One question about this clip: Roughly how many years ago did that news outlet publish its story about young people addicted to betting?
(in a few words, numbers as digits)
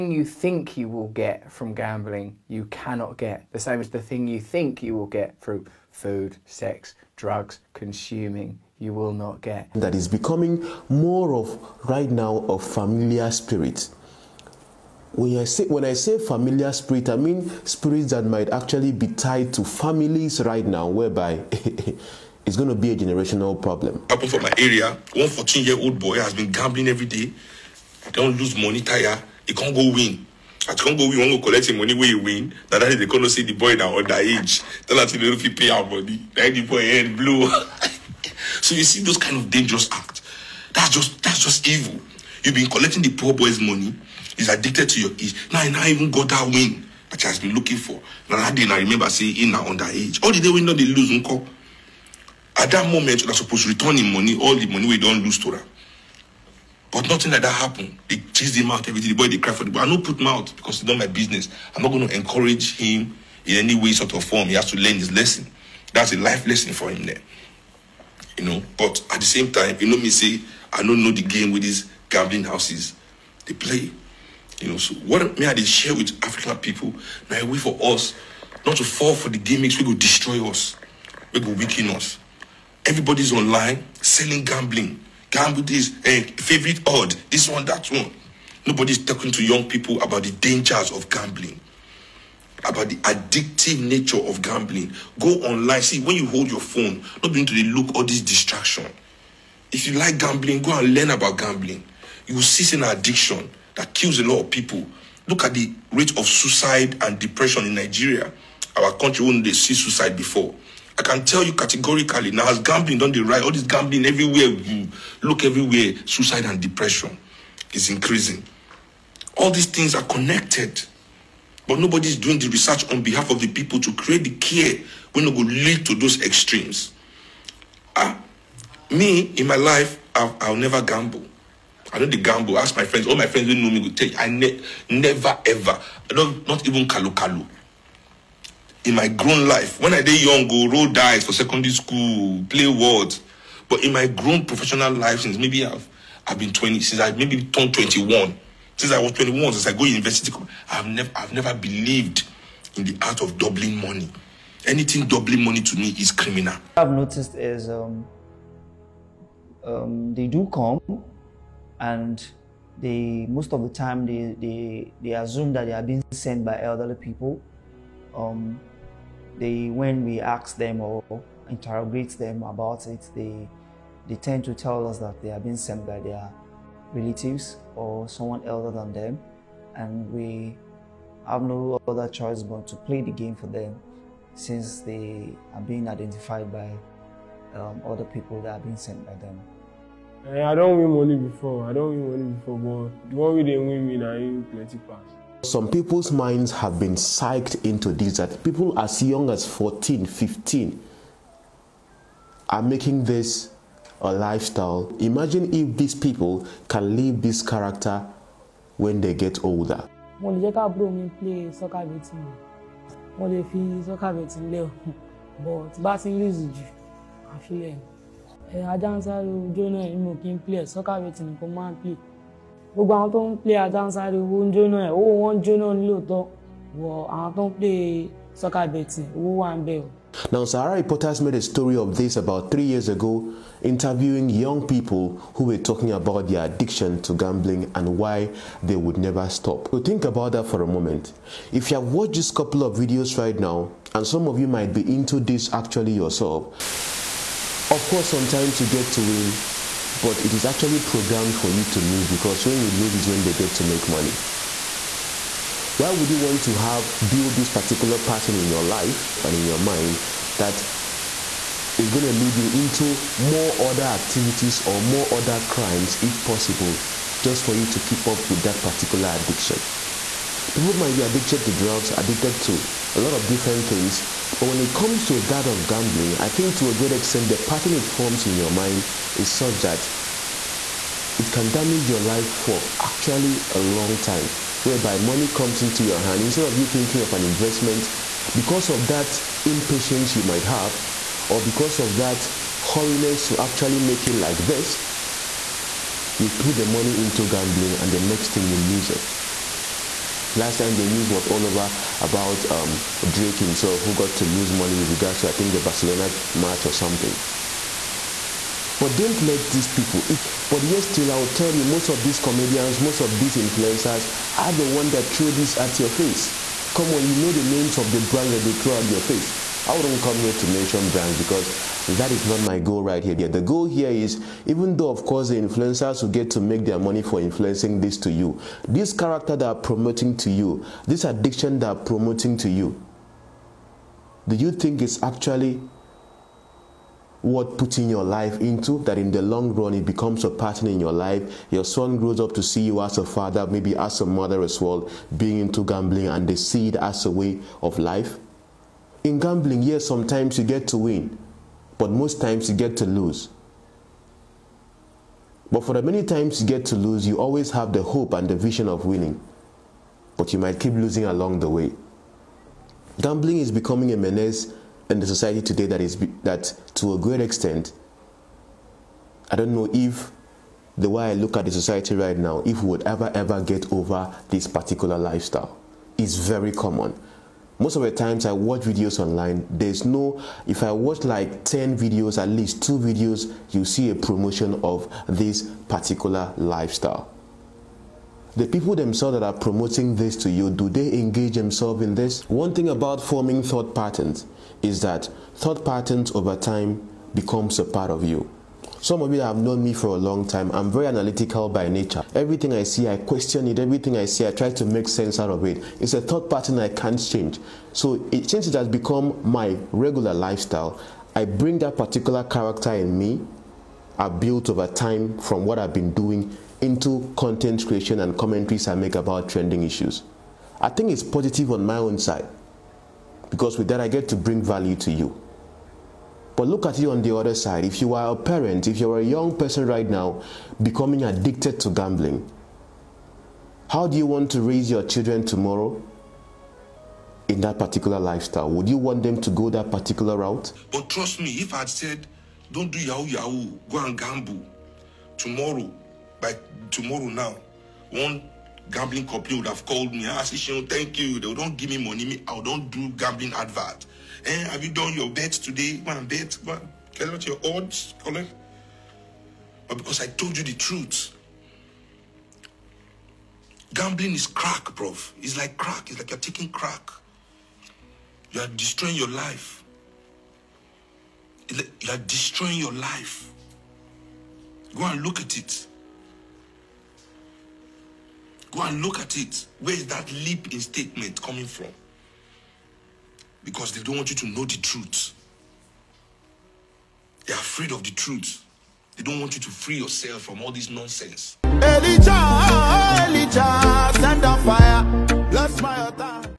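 3 years.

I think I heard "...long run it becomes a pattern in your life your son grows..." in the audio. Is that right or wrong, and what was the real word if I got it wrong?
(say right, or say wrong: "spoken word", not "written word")
right.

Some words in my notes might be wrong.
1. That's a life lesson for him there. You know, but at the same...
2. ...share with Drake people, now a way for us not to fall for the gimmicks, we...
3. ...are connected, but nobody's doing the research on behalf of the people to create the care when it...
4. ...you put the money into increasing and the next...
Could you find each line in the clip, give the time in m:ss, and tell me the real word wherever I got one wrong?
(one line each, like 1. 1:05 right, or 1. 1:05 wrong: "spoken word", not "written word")
1. 1:05 right
2. 1:15 wrong: "African", not "Drake"
3. 1:59 right
4. 4:56 wrong: "gambling", not "increasing".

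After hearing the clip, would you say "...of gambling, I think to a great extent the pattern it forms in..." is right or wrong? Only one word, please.
right.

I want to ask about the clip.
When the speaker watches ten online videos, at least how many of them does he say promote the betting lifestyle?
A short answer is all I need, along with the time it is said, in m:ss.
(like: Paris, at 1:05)
2, at 6:22.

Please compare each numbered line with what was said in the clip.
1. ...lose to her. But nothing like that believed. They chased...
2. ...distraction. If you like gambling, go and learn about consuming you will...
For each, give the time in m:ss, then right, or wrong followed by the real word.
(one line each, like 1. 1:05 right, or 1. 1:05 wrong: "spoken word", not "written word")
1. 0:55 wrong: "happened", not "believed"
2. 1:38 wrong: "gambling", not "consuming".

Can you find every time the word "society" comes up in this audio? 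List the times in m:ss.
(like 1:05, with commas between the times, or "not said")
6:05, 6:11.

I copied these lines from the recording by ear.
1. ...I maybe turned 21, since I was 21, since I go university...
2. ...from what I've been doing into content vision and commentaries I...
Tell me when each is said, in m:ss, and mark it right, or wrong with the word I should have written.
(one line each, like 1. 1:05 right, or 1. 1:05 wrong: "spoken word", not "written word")
1. 2:26 right
2. 6:55 wrong: "creation", not "vision".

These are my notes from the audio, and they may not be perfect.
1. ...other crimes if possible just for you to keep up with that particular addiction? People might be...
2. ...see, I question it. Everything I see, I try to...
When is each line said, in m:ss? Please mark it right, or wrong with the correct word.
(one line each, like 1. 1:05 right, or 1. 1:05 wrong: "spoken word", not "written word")
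1. 4:25 right
2. 6:42 right.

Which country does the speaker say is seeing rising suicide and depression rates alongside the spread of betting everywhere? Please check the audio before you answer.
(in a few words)
Nigeria.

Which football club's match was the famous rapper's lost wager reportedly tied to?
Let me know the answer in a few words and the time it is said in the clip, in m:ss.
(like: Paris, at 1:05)
Barcelona, at 5:05.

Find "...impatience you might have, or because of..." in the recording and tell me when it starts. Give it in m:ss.
4:49.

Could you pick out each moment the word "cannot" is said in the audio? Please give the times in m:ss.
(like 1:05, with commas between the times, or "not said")
0:02, 0:33.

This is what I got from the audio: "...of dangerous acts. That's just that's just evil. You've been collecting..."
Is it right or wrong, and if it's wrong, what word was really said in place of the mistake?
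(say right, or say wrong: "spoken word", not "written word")
right.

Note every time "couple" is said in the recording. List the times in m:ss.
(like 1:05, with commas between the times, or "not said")
4:02.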